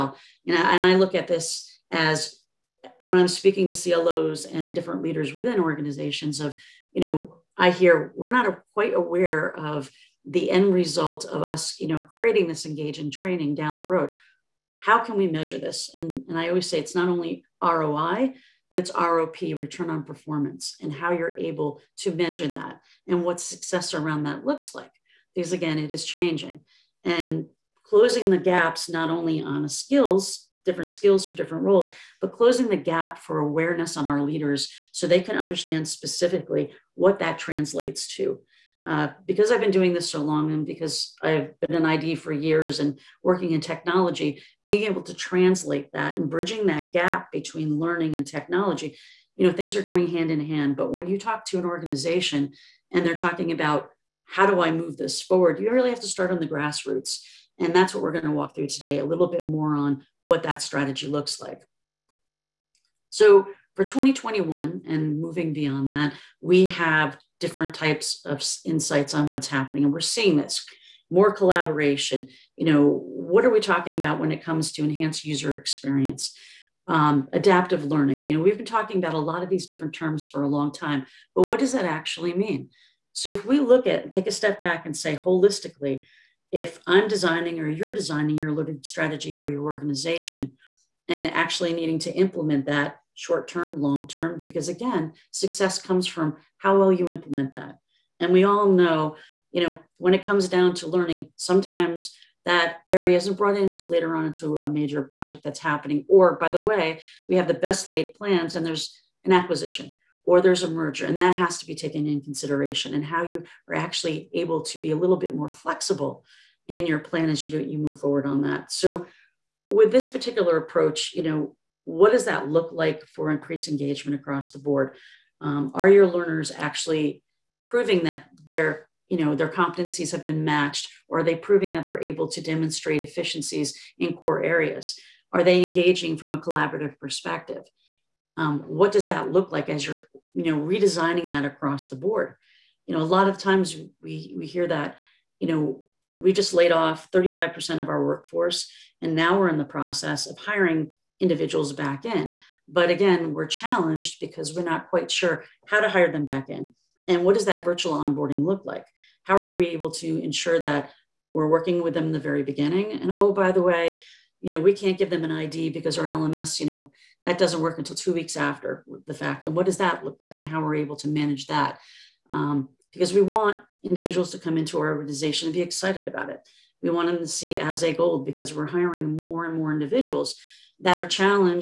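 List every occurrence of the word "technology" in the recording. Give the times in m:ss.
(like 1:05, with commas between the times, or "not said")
0:43, 0:48.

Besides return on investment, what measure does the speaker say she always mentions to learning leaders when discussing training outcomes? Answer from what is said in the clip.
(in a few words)
Return on performance.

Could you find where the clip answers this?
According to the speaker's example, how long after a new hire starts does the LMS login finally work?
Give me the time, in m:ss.
2:47.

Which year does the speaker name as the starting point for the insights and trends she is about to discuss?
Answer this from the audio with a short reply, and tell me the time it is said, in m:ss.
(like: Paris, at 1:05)
2021, at 1:03.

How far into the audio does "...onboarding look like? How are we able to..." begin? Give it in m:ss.
2:37.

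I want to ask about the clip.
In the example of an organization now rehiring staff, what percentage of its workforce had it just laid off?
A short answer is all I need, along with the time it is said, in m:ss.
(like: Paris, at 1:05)
35%, at 2:27.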